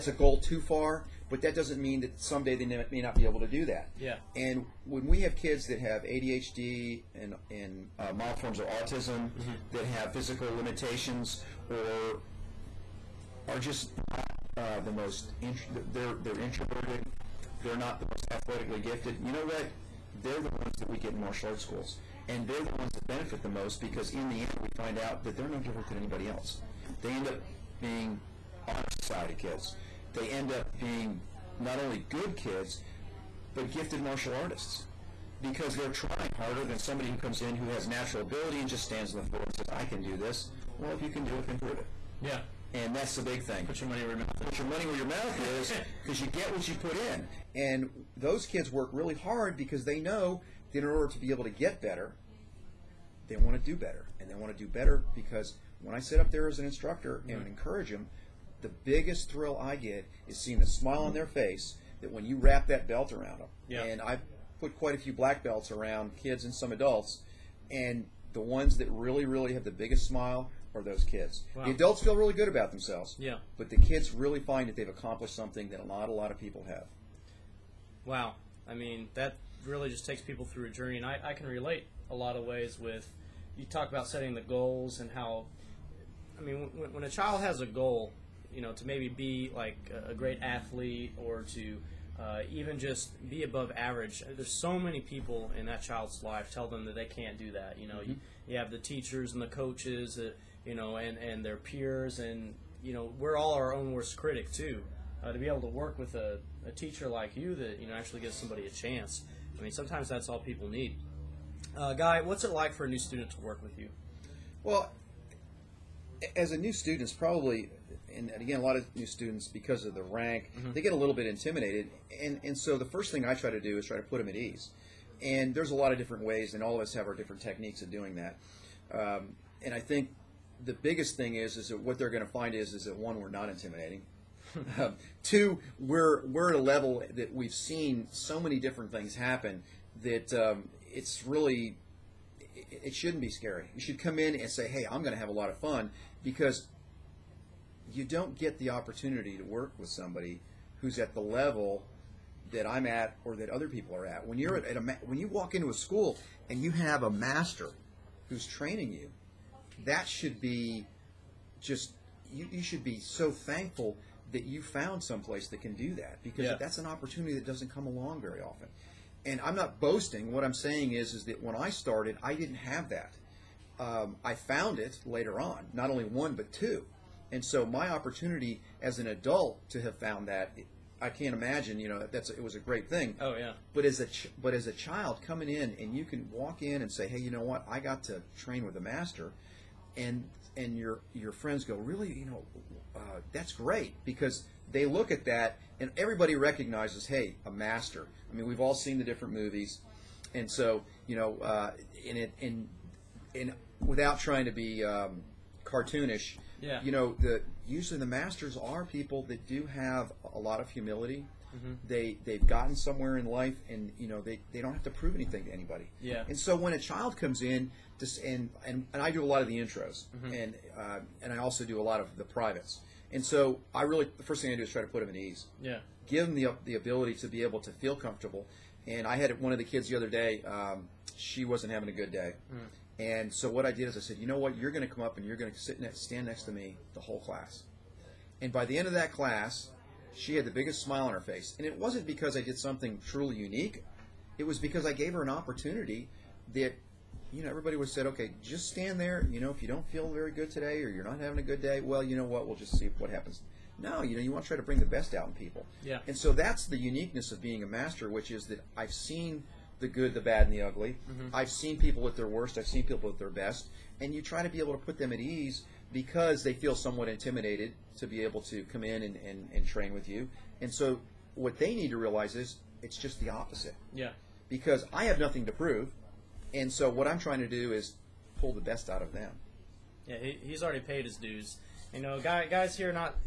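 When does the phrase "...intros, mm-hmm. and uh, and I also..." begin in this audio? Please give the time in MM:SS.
03:39.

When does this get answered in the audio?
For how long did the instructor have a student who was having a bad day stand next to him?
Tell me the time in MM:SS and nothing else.
03:56.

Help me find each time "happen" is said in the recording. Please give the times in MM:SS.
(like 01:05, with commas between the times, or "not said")
02:19, 04:13.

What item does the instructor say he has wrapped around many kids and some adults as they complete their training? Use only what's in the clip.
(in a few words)
Black belts.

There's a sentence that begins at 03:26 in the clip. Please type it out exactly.
You know, the, usually the masters are people that do have a lot of humility.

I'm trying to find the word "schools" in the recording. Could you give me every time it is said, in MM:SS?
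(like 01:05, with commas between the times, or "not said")
00:21, 02:35.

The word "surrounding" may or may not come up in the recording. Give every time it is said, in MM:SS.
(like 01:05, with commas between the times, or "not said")
not said.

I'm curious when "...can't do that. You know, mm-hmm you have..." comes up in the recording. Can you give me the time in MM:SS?
01:37.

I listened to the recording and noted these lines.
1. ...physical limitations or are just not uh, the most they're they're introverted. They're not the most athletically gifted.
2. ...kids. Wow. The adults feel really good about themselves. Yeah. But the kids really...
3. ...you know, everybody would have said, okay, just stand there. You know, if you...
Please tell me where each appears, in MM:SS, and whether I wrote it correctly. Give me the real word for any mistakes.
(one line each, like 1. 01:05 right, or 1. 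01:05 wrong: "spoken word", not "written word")
1. 00:10 right
2. 01:11 right
3. 04:07 right.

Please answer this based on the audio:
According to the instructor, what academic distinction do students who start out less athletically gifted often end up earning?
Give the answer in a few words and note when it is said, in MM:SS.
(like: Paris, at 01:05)
Honor society, at 00:28.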